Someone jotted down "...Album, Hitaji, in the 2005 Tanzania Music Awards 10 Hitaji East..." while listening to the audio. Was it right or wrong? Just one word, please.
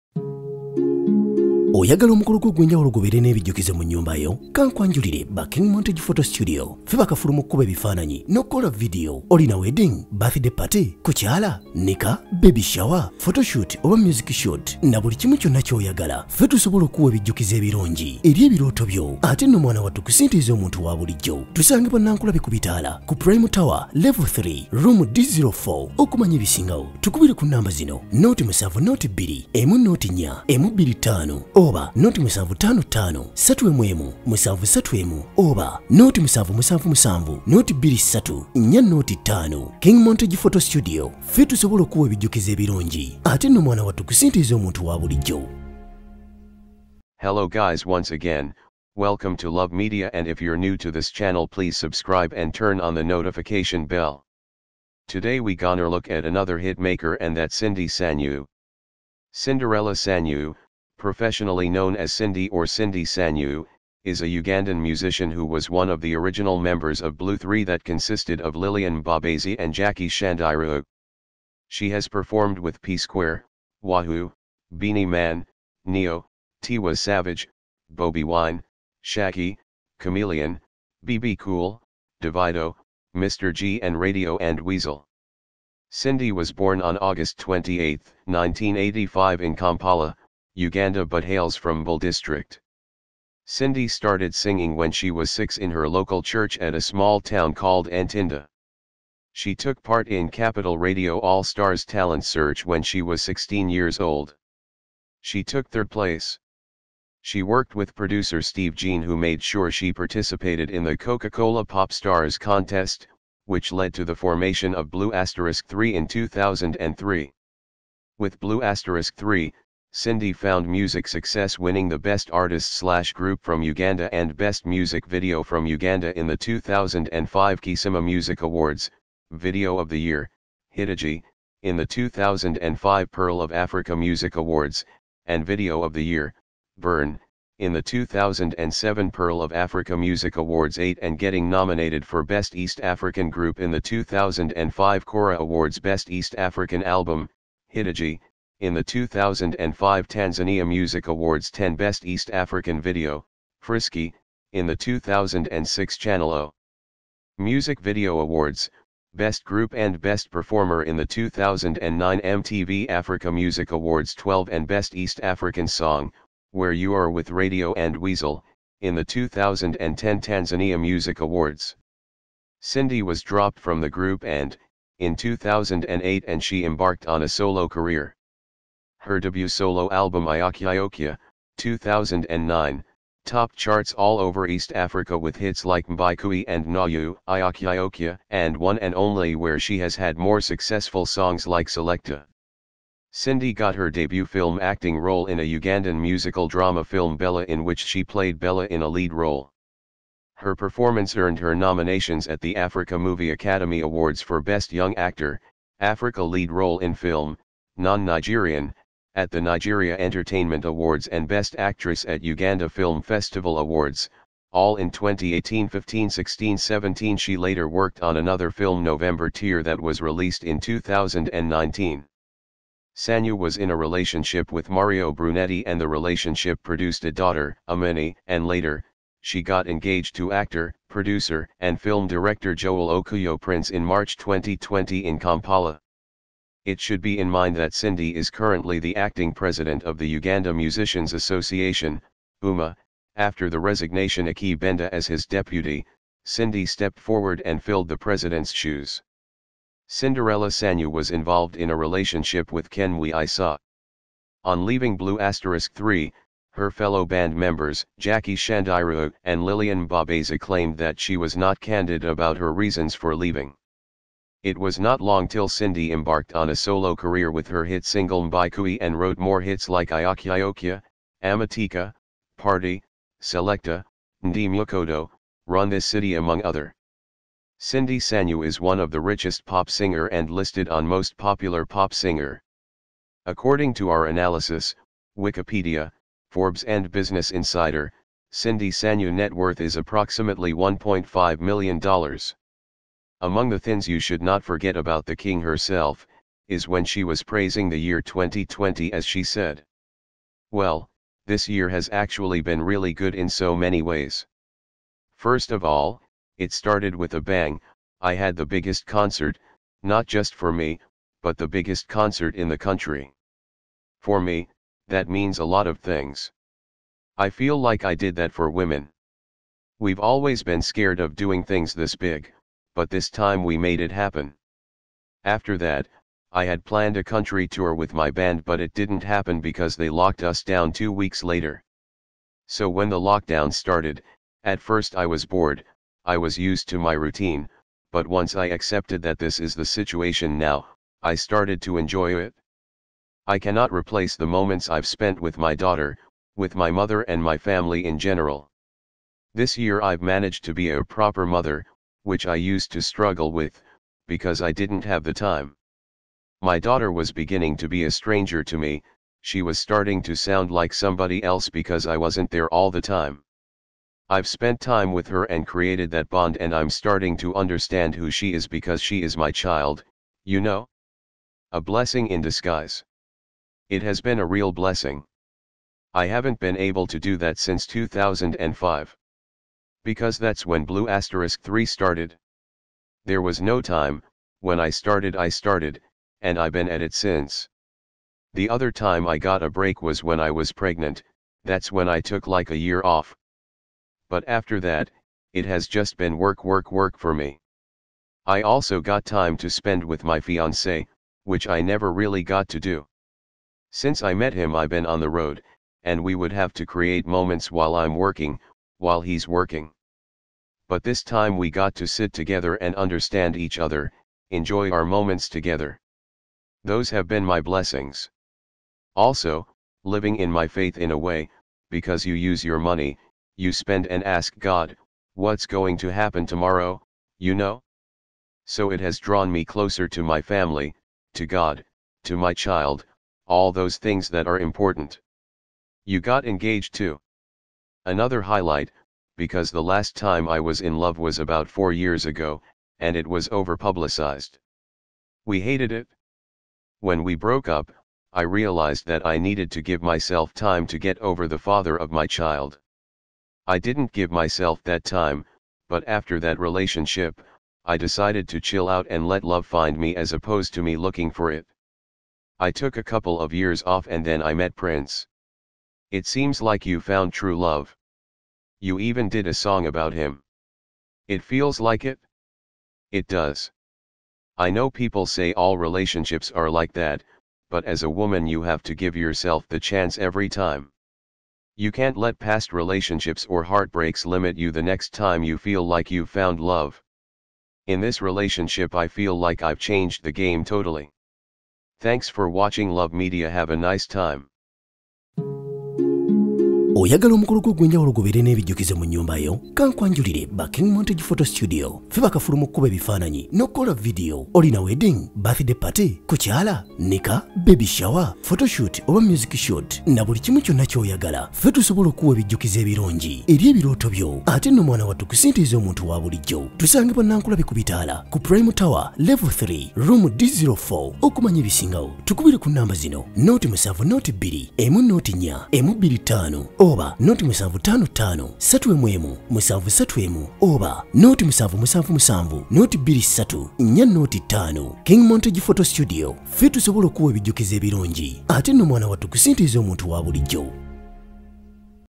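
wrong.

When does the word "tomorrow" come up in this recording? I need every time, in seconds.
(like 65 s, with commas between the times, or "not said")
426 s.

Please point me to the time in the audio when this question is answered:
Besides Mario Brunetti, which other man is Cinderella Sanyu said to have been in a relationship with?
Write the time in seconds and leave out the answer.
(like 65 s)
252 s.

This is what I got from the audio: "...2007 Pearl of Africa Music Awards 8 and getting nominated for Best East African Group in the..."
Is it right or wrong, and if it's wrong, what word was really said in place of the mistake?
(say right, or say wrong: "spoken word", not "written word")
right.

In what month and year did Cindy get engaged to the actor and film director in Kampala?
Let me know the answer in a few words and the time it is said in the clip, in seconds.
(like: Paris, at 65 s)
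March 2020, at 233 s.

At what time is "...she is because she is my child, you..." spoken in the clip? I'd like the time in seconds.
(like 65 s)
368 s.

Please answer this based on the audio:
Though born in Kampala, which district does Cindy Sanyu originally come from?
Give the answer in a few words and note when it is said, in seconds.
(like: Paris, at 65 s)
Bull district, at 91 s.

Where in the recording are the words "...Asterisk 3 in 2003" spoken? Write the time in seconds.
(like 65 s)
115 s.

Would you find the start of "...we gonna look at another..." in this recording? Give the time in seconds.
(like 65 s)
55 s.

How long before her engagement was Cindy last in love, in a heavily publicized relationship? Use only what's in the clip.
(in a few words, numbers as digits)
about 4 years ago.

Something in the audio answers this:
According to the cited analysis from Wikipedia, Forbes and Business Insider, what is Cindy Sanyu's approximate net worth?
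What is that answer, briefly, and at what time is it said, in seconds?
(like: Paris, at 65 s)
$1.5 million, at 290 s.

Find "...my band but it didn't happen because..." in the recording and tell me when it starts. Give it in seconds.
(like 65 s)
327 s.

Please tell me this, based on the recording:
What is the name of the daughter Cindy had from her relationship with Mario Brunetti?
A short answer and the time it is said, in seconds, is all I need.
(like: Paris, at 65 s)
Amini, at 227 s.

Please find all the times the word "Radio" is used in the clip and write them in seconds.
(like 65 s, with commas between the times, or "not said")
83 s, 100 s, 167 s.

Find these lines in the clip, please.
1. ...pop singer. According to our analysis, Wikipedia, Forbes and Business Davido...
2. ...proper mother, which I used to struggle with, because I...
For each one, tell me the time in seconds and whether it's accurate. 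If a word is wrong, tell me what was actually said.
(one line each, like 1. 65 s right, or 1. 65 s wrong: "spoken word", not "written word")
1. 281 s wrong: "Insider", not "Davido"
2. 350 s right.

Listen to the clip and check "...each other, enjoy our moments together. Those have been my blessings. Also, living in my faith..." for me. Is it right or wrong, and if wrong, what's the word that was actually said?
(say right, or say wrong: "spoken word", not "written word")
right.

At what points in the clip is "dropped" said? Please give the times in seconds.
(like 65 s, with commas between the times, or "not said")
173 s.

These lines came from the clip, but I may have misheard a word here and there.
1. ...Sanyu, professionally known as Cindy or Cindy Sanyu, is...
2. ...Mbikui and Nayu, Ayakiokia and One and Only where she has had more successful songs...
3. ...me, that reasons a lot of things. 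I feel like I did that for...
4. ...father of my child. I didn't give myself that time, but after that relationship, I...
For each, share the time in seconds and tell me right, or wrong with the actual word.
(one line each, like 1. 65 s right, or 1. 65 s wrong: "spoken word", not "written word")
1. 59 s right
2. 185 s right
3. 314 s wrong: "means", not "reasons"
4. 451 s right.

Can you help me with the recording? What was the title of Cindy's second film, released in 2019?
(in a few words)
November Tear.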